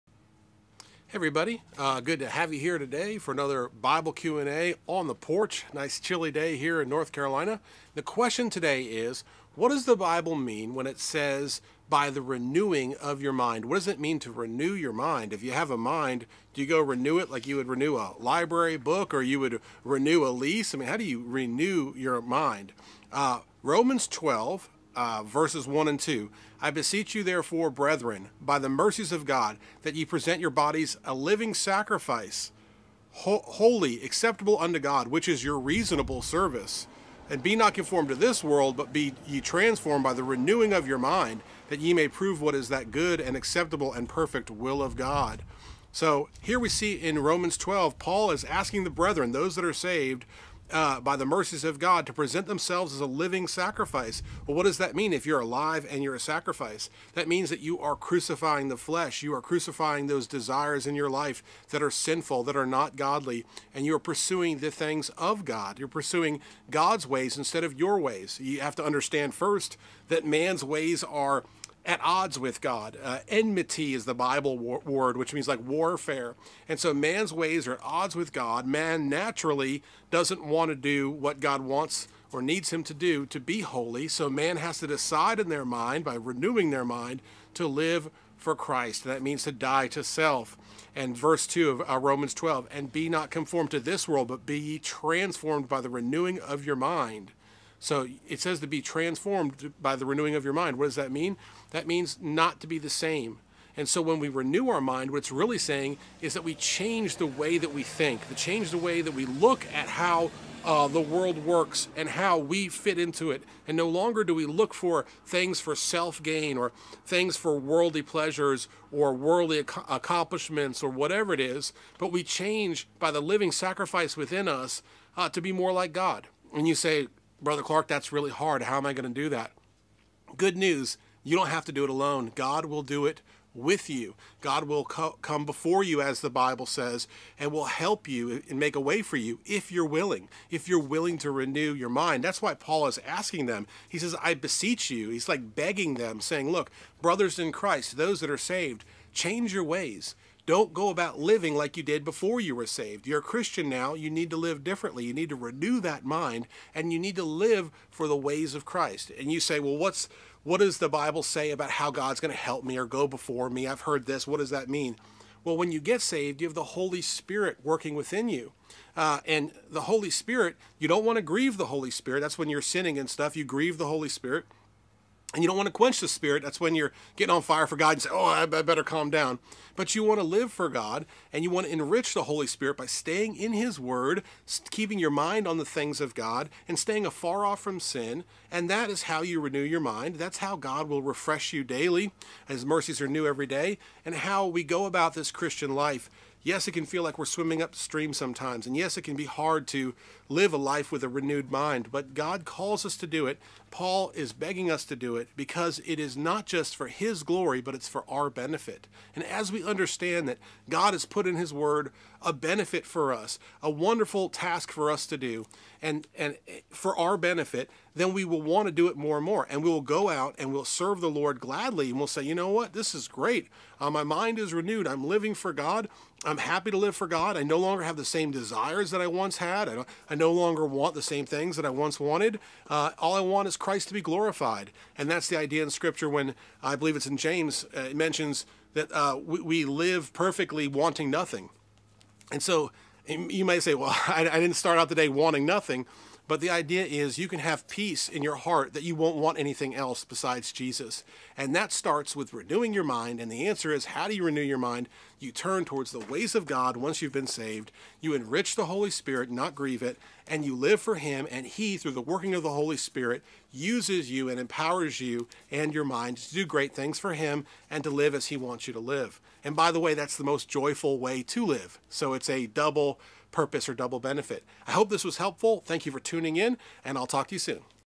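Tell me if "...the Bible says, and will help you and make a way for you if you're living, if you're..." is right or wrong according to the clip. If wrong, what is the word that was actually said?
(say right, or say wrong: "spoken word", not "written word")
wrong: "willing", not "living".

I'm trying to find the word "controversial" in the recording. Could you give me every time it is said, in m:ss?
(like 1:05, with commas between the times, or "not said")
not said.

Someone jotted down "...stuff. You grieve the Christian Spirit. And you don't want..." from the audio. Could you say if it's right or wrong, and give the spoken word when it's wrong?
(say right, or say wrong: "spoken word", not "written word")
wrong: "Holy", not "Christian".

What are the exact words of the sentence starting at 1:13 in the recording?
Uh, enmity is the Bible word, which means like warfare.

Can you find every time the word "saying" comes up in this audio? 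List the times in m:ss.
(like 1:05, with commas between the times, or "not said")
1:45, 2:26.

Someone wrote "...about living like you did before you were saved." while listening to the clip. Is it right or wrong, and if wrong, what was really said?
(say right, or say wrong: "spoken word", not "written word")
right.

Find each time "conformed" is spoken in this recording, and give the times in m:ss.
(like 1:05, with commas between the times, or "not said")
0:37, 1:33.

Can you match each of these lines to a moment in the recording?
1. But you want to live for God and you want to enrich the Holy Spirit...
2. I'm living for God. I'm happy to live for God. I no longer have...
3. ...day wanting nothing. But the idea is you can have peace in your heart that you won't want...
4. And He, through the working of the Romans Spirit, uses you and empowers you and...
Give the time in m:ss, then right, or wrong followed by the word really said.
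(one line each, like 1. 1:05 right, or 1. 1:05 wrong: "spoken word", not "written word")
1. 2:59 right
2. 3:44 right
3. 4:04 right
4. 4:21 wrong: "Holy", not "Romans".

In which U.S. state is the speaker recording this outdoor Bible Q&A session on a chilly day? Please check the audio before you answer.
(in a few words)
North Carolina.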